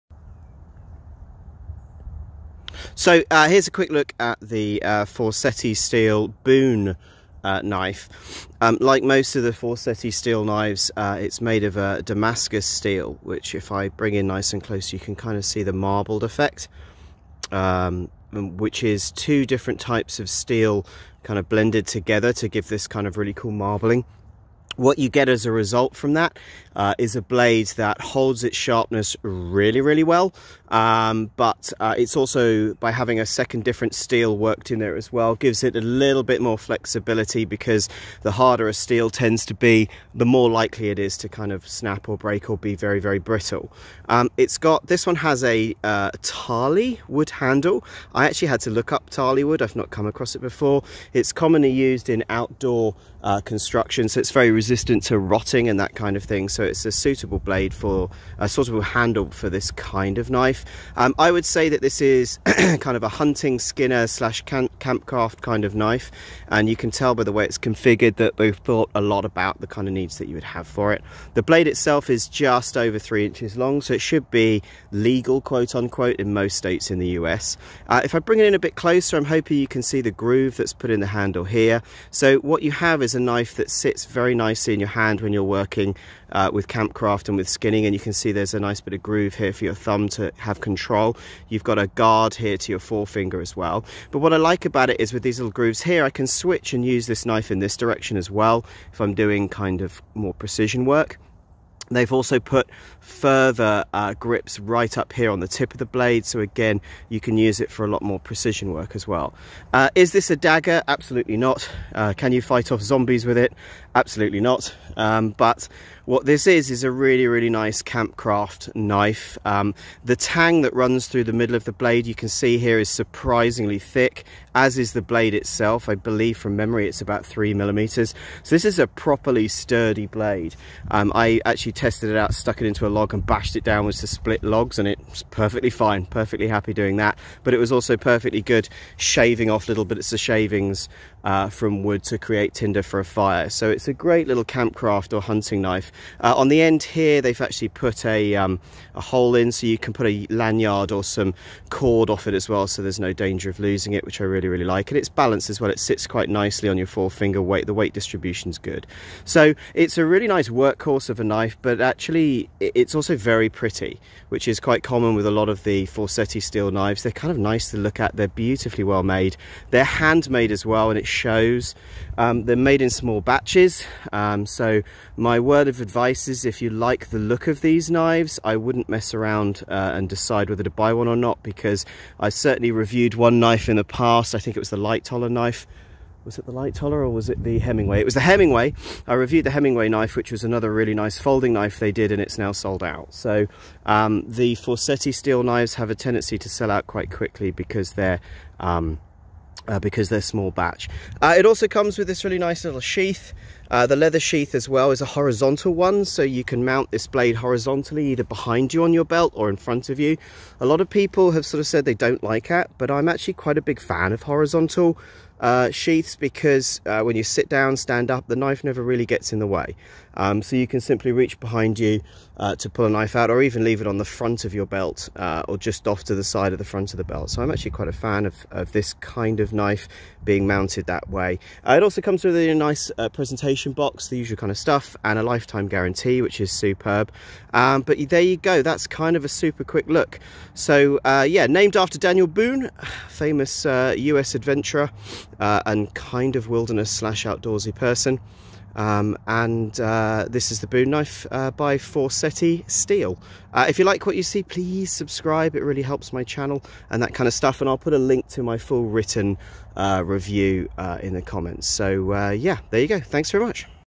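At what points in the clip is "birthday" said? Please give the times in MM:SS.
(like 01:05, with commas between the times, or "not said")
not said.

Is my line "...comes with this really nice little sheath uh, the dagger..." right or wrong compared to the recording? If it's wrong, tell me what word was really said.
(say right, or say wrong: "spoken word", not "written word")
wrong: "leather", not "dagger".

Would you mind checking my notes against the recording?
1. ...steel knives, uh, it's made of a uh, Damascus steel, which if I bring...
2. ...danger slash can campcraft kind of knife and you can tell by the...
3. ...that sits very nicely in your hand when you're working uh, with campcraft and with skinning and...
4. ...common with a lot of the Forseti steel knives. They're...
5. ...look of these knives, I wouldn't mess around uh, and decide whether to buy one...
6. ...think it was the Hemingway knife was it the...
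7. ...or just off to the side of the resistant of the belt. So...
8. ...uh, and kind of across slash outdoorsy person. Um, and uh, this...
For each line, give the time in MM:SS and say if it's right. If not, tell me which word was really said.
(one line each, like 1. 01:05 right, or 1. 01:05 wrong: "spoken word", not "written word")
1. 00:10 right
2. 01:03 wrong: "skinner", not "danger"
3. 01:23 right
4. 02:44 right
5. 02:57 right
6. 03:04 wrong: "Lightoller", not "Hemingway"
7. 03:45 wrong: "front", not "resistant"
8. 04:05 wrong: "wilderness", not "across".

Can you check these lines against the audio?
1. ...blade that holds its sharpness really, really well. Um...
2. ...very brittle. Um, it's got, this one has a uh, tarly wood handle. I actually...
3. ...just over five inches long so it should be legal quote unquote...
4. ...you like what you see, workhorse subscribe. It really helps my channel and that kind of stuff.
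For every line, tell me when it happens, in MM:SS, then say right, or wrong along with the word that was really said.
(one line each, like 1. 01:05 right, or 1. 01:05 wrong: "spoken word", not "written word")
1. 00:27 right
2. 00:43 right
3. 01:12 wrong: "three", not "five"
4. 04:13 wrong: "please", not "workhorse".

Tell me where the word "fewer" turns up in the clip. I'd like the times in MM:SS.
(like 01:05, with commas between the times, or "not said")
not said.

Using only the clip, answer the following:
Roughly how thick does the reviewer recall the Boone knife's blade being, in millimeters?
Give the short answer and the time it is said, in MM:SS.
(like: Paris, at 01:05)
3 millimeters, at 02:07.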